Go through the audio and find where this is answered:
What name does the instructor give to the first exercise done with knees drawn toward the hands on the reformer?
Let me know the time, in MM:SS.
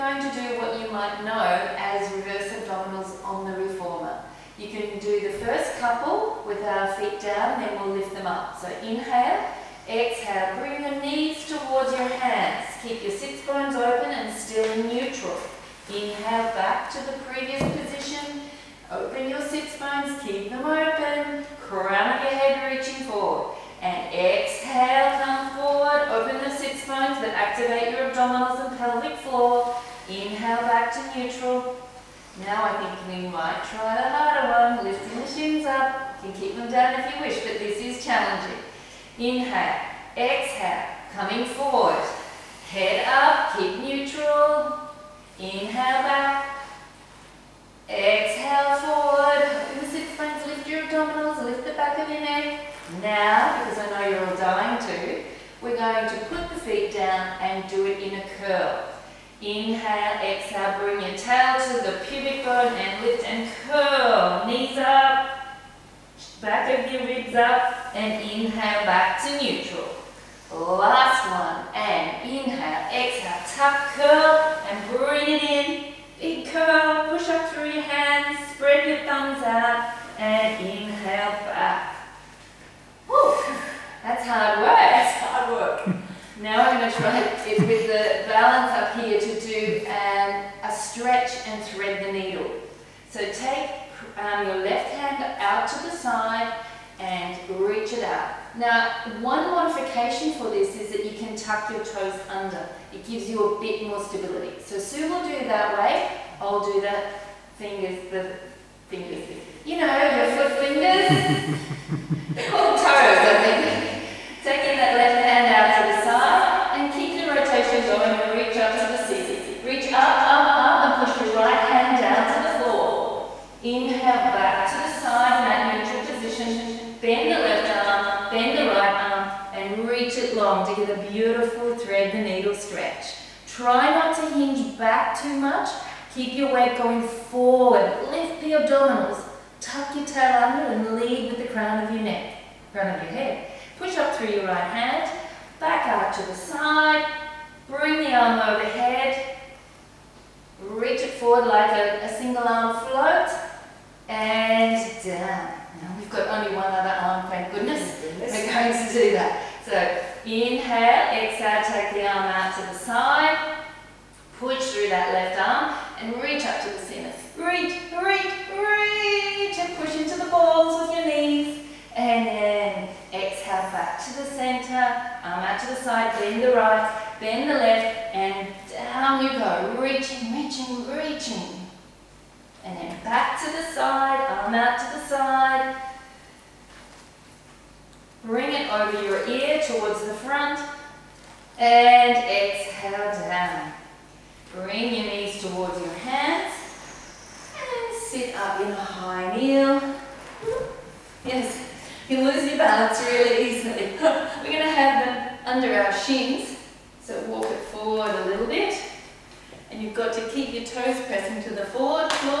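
00:02.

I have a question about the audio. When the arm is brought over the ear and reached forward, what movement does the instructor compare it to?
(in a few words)
single arm float.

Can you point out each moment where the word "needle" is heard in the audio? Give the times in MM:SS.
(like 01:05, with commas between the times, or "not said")
01:32, 02:12.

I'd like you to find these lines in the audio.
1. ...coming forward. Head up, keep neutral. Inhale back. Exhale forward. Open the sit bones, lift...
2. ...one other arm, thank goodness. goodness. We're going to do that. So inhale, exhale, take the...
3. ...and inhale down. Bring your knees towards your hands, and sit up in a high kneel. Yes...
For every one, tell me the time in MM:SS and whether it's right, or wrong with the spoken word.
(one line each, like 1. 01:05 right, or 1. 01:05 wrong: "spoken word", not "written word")
1. 00:41 right
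2. 02:36 right
3. 03:11 wrong: "exhale", not "inhale".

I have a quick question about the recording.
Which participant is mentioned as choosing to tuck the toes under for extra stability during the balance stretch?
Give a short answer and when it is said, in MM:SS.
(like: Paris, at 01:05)
Sue, at 01:44.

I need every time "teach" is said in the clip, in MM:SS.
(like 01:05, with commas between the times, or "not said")
not said.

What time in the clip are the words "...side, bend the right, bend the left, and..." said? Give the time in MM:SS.
02:55.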